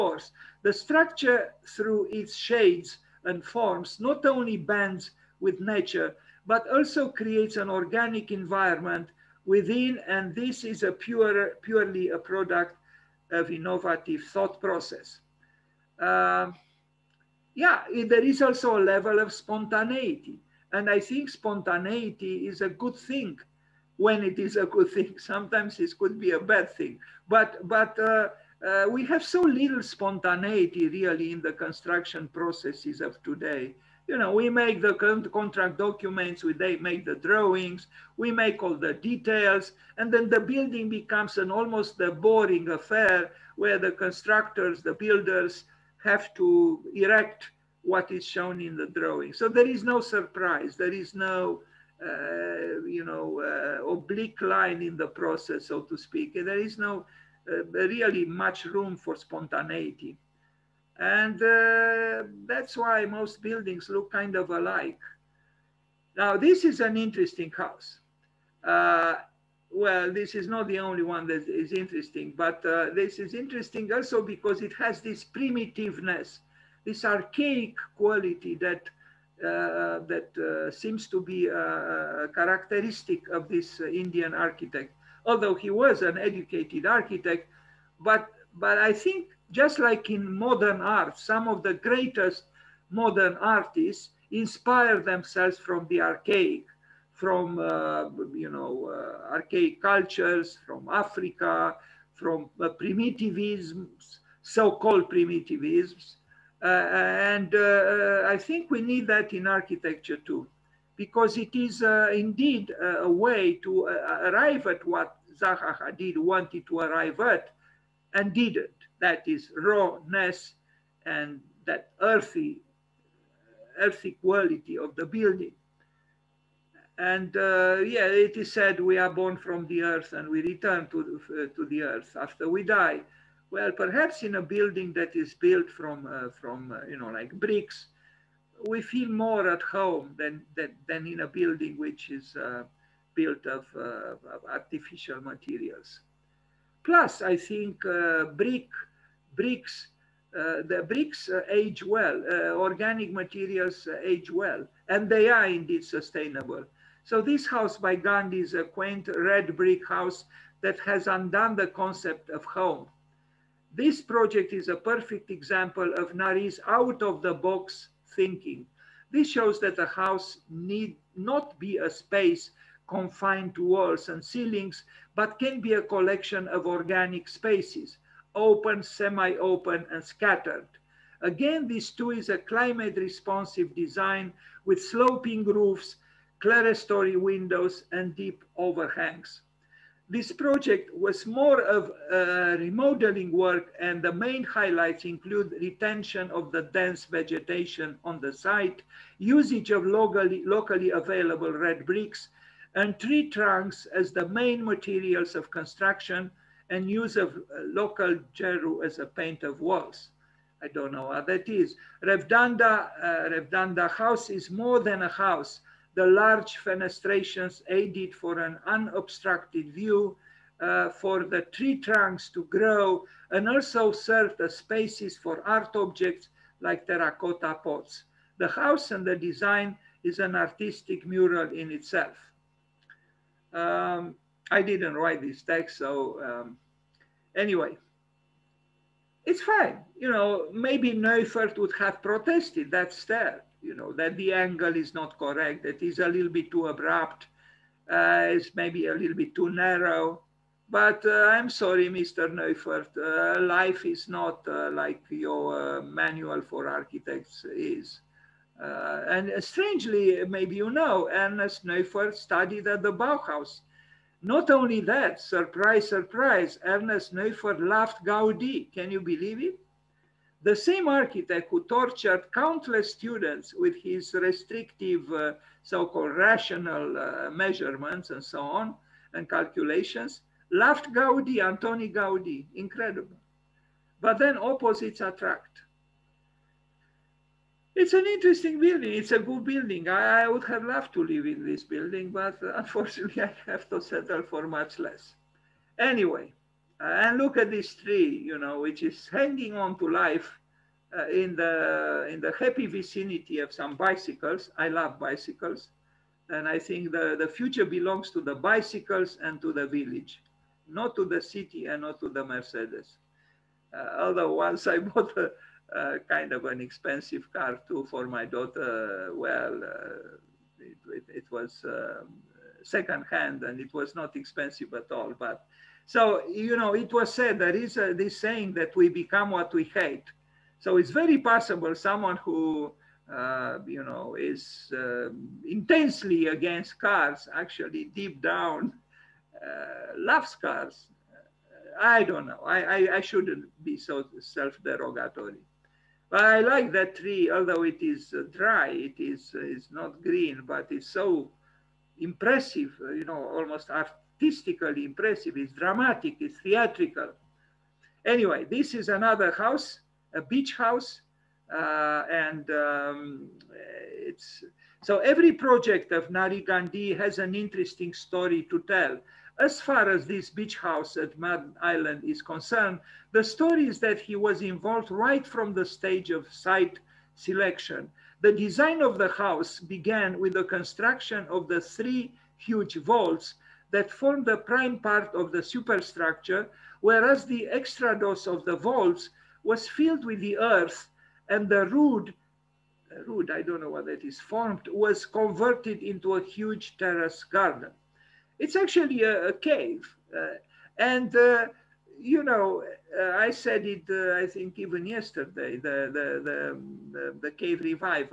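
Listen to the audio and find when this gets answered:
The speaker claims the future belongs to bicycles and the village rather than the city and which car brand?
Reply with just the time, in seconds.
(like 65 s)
312 s.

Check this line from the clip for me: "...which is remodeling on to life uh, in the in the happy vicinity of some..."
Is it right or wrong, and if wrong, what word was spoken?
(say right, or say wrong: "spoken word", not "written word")
wrong: "hanging", not "remodeling".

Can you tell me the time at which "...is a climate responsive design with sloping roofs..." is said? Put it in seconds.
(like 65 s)
182 s.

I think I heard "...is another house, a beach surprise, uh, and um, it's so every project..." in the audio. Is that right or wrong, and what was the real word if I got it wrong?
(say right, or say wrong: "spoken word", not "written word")
wrong: "house", not "surprise".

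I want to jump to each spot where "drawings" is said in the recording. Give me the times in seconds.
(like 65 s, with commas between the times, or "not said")
37 s, 48 s.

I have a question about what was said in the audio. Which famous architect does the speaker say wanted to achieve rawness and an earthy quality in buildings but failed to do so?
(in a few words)
Zaha Hadid.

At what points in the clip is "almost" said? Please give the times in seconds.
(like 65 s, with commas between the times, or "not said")
41 s, 353 s.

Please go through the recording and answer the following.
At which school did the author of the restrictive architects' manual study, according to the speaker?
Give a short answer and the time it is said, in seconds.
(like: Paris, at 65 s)
Bauhaus, at 262 s.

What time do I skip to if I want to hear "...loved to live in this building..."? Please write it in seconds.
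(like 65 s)
290 s.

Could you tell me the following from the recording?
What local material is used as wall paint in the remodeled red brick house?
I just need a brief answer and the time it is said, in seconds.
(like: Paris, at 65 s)
geru, at 208 s.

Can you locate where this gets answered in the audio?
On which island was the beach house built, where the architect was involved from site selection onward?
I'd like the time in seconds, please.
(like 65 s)
371 s.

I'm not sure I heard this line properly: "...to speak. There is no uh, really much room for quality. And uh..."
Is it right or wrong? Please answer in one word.
wrong.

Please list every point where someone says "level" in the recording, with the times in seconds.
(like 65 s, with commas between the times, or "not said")
18 s.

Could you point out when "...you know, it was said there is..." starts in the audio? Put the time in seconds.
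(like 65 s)
326 s.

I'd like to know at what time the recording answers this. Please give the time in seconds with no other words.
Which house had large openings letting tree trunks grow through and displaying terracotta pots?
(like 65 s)
213 s.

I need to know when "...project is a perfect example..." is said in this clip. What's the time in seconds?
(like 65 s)
164 s.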